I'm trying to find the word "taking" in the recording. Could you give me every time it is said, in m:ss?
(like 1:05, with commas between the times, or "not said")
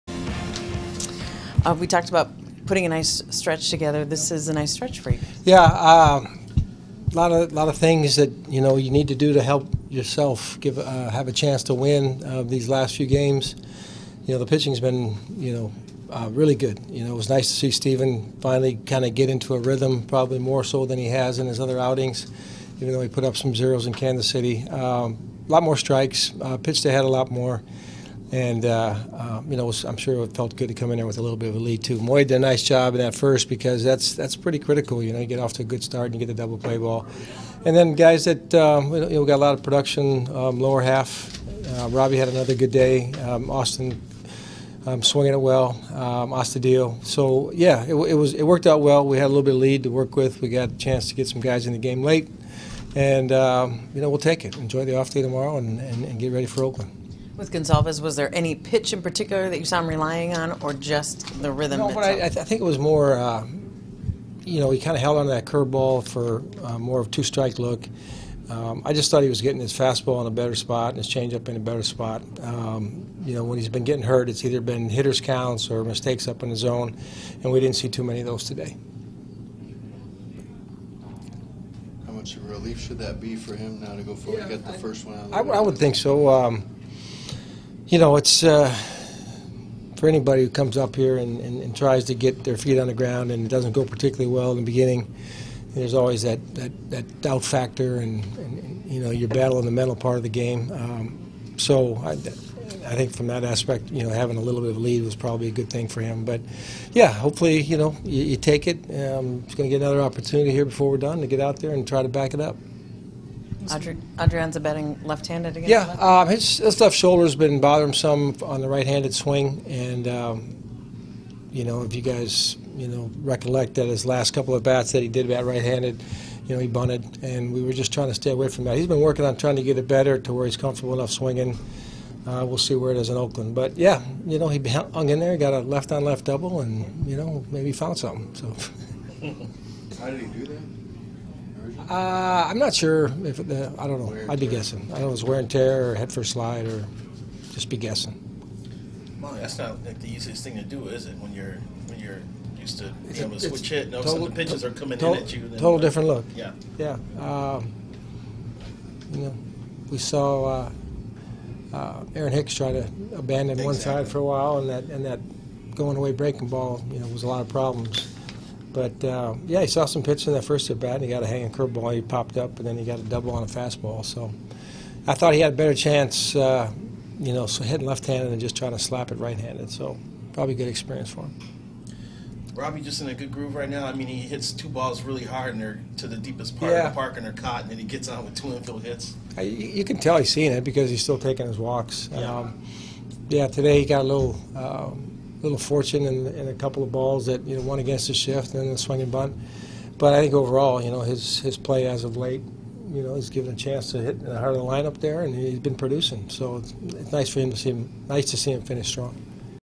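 3:11.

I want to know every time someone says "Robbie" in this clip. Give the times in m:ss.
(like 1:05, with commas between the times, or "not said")
0:41, 3:02.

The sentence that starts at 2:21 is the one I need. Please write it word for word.
Uh, I'm not sure if uh, I don't know.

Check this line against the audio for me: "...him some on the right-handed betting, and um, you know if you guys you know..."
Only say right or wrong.
wrong.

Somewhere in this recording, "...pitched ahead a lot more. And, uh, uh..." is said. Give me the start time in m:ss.
0:26.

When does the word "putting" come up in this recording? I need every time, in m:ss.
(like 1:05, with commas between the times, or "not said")
0:02.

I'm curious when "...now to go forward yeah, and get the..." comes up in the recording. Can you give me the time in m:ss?
1:23.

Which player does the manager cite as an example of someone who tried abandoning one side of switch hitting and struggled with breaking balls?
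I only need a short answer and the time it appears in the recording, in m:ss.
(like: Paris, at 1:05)
Aaron Hicks, at 2:42.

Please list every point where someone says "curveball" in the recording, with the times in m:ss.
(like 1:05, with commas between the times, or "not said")
1:05, 2:51.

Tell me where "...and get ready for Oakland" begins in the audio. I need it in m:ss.
0:56.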